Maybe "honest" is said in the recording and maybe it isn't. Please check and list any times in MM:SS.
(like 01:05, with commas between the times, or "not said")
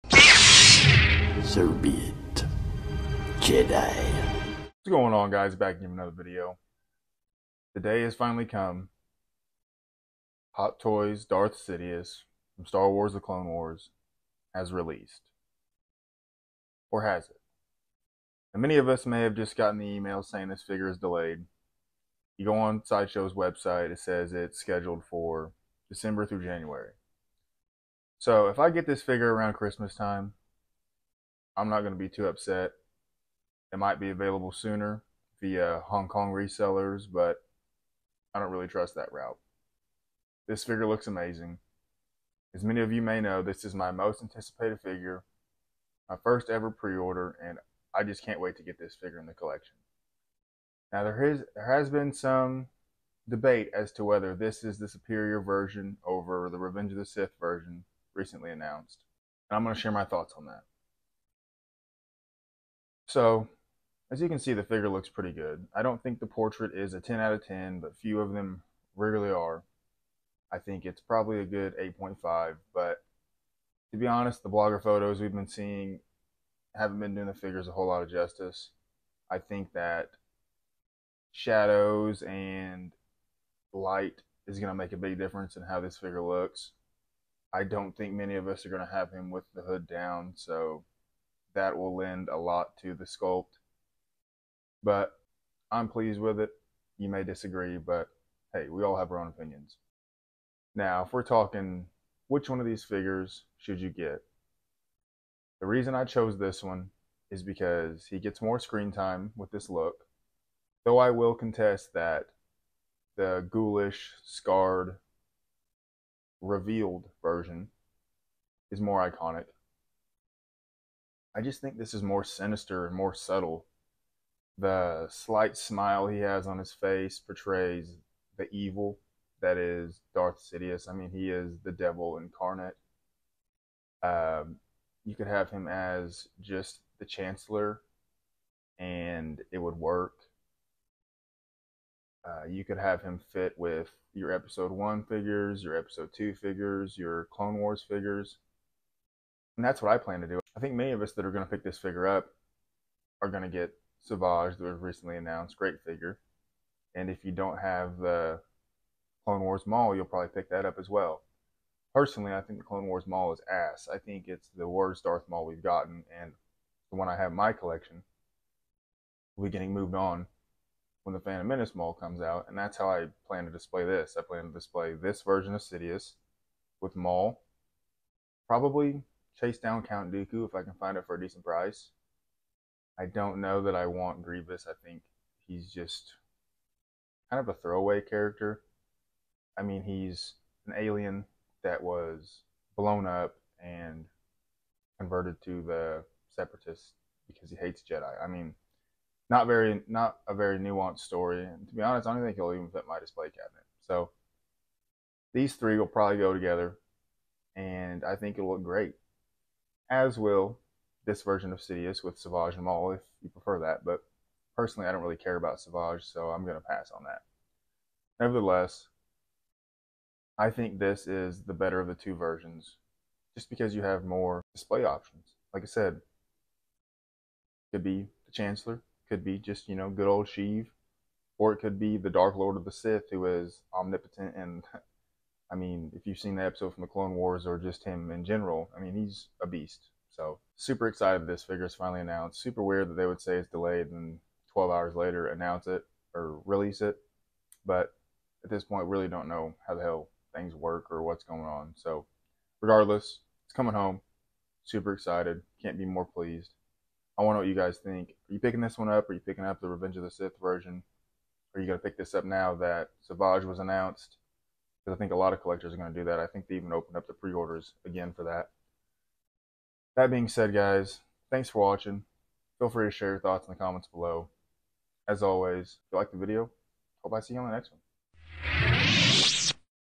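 01:14, 03:21.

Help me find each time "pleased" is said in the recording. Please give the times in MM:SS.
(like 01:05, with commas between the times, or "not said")
01:35, 04:16.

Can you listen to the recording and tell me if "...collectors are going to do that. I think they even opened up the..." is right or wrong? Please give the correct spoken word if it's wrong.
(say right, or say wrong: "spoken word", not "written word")
right.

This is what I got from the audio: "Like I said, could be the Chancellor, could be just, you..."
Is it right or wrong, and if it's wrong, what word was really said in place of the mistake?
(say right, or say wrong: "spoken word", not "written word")
right.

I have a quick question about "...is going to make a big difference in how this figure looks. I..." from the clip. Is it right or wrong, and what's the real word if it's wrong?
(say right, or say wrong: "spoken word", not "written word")
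right.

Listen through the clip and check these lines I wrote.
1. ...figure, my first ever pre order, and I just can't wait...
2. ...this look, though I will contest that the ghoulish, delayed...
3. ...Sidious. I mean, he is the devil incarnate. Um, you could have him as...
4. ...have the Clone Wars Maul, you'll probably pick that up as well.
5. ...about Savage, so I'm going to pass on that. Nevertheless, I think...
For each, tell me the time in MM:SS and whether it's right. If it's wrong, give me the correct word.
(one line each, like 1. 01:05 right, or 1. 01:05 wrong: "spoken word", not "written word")
1. 00:44 right
2. 01:49 wrong: "scarred", not "delayed"
3. 02:10 right
4. 02:37 right
5. 03:35 right.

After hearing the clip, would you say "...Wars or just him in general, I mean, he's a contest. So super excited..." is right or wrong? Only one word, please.
wrong.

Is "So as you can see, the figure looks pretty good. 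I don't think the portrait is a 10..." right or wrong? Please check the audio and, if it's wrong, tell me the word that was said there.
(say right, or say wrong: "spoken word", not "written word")
right.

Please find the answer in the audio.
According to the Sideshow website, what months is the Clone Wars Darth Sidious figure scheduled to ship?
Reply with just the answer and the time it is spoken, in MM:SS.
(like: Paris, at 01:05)
December through January, at 00:25.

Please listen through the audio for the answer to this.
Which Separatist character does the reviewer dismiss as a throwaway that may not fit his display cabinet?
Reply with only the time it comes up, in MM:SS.
03:04.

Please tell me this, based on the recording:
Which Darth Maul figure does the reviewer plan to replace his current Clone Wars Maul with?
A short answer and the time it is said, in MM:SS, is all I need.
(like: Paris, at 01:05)
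Phantom Menace Maul, at 02:51.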